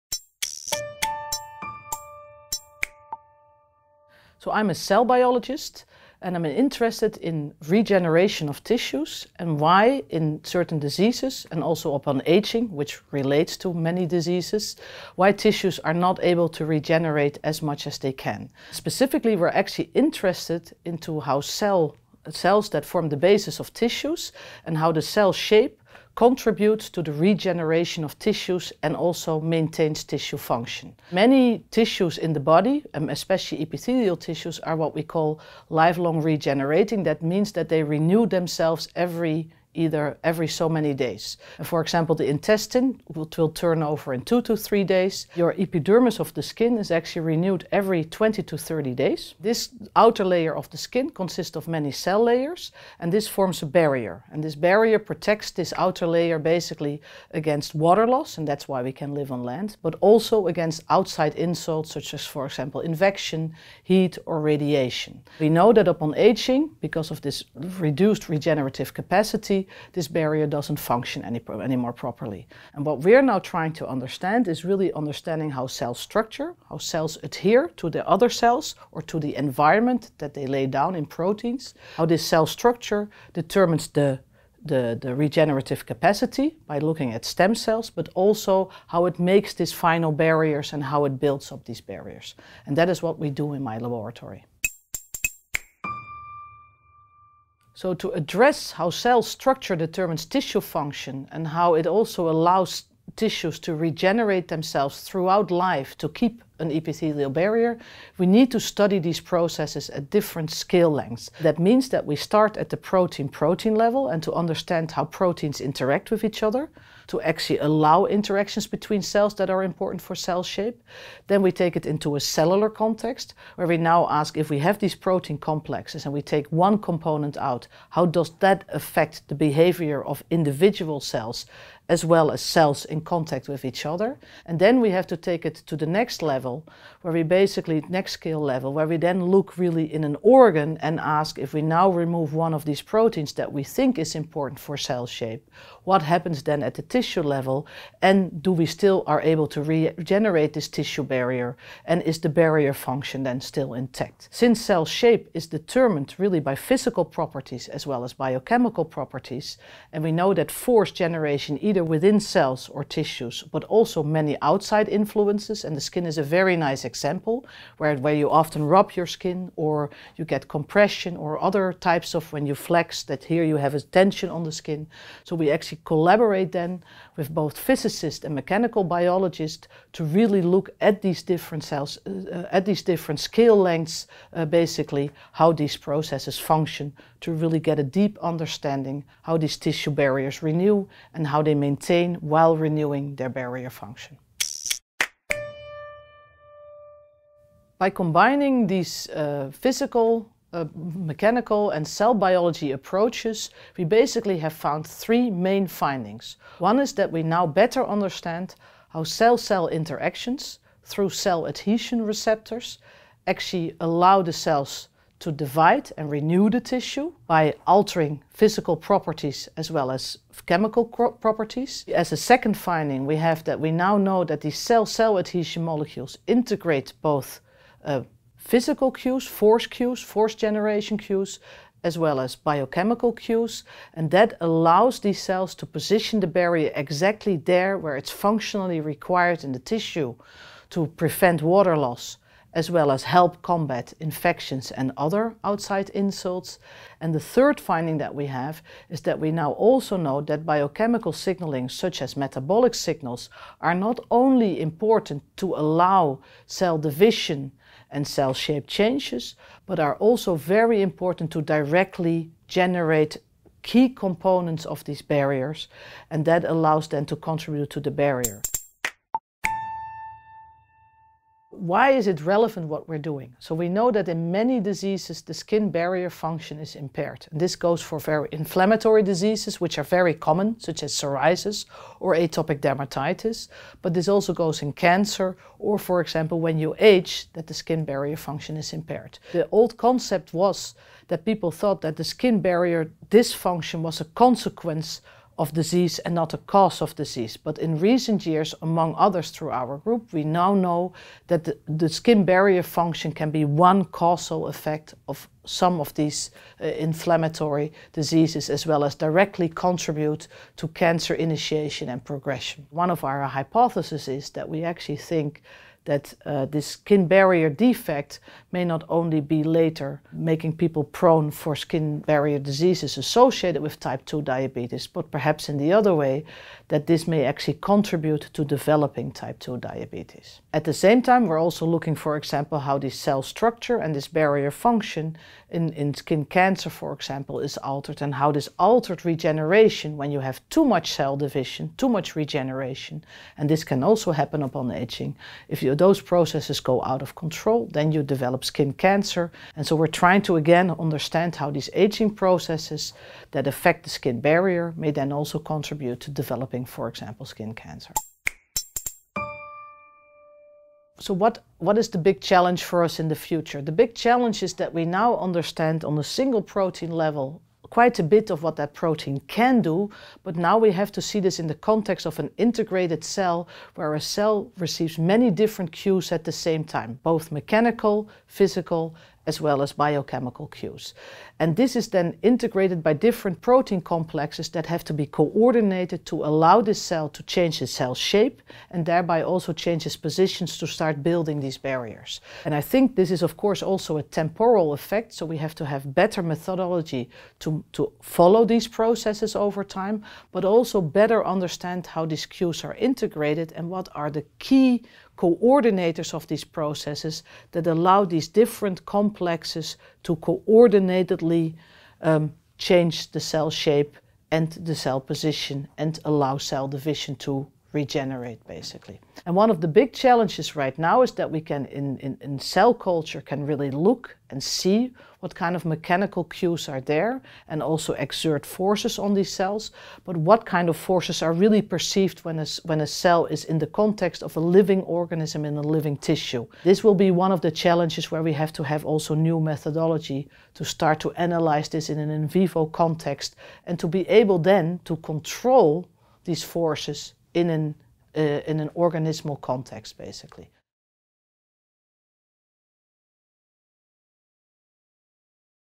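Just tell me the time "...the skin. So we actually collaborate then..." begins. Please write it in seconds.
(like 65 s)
174 s.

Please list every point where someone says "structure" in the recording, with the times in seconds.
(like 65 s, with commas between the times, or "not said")
75 s, 82 s, 99 s, 333 s.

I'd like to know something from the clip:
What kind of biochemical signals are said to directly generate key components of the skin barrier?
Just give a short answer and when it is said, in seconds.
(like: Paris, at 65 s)
Metabolic signals, at 252 s.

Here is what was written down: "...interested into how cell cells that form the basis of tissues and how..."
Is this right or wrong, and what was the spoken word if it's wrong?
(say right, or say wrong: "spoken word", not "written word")
right.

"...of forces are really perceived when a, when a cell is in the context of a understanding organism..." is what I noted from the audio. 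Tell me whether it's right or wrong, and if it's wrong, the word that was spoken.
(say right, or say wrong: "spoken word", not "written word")
wrong: "living", not "understanding".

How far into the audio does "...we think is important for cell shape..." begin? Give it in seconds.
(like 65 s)
143 s.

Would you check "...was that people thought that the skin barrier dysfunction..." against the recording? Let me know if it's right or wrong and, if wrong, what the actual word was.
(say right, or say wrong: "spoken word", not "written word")
right.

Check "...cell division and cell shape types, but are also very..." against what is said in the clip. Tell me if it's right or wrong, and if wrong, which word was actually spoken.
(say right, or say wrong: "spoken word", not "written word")
wrong: "changes", not "types".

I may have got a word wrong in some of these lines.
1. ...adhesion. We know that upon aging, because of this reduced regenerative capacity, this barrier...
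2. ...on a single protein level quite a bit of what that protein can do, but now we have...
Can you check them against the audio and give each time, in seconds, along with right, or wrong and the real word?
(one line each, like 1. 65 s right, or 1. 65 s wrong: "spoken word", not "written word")
1. 64 s wrong: "radiation", not "adhesion"
2. 365 s right.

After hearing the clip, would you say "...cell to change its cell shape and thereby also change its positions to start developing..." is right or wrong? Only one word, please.
wrong.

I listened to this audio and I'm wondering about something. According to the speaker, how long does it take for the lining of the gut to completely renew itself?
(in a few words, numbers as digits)
2 to 3 days.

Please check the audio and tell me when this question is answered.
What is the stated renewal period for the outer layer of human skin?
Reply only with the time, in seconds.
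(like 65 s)
48 s.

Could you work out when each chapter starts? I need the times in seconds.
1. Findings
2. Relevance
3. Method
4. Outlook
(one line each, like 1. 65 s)
1. 194 s
2. 269 s
3. 95 s
4. 358 s.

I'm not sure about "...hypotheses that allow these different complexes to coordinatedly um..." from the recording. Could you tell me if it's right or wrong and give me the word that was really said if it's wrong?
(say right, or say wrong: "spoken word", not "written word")
wrong: "processes", not "hypotheses".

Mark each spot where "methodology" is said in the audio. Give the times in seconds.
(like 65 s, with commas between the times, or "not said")
396 s, 439 s.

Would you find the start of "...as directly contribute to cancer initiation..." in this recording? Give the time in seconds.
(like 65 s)
308 s.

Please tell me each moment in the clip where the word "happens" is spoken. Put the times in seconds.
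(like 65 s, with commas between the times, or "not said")
146 s, 344 s.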